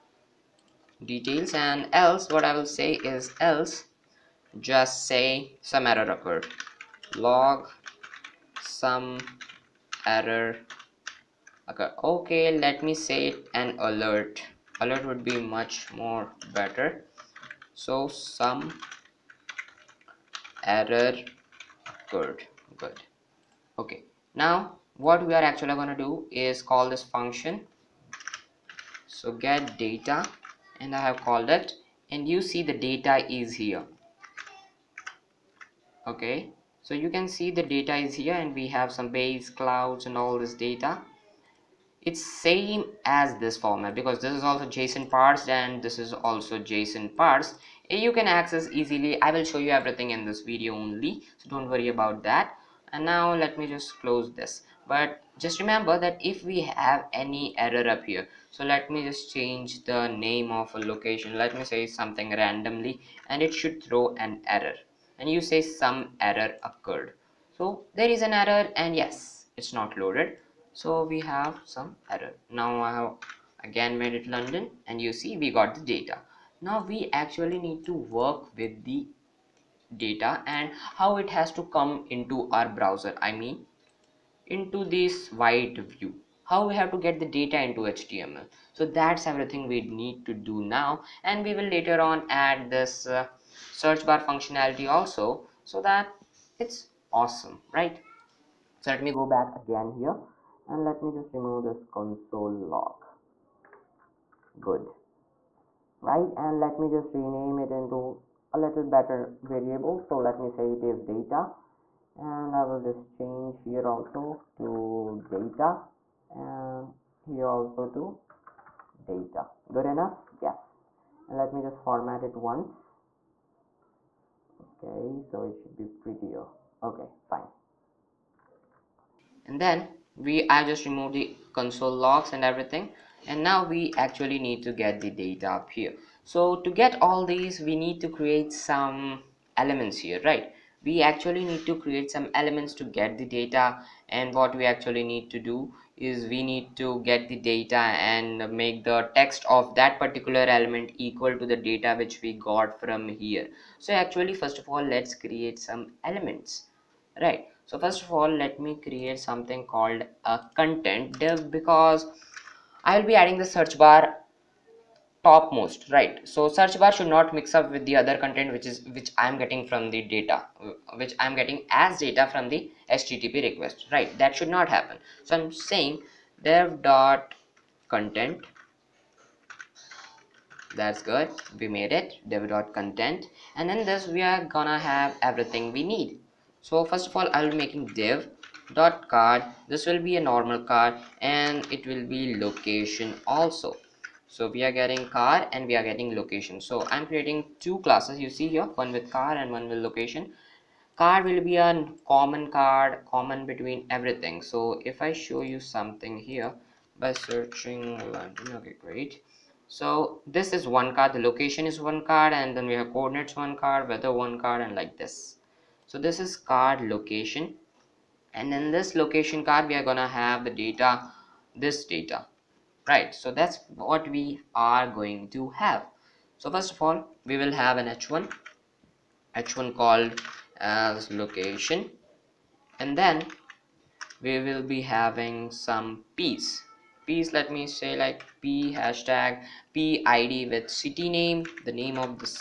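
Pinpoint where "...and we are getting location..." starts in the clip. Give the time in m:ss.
3:15.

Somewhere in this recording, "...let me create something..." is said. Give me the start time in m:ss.
2:38.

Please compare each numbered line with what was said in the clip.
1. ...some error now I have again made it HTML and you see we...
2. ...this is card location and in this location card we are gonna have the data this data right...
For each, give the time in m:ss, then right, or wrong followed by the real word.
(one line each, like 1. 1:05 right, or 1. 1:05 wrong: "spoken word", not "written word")
1. 1:11 wrong: "London", not "HTML"
2. 3:35 right.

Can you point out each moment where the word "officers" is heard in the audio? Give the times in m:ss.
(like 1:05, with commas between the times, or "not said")
not said.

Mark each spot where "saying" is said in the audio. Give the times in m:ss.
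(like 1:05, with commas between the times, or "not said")
2:55.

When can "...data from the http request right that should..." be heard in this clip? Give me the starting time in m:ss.
2:52.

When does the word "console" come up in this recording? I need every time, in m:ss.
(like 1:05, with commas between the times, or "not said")
1:41, 2:11.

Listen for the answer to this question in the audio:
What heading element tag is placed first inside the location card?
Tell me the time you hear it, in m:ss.
3:49.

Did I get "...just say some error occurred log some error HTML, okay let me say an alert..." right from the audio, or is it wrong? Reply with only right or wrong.
wrong.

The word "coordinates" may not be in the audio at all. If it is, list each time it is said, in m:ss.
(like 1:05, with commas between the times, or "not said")
3:32.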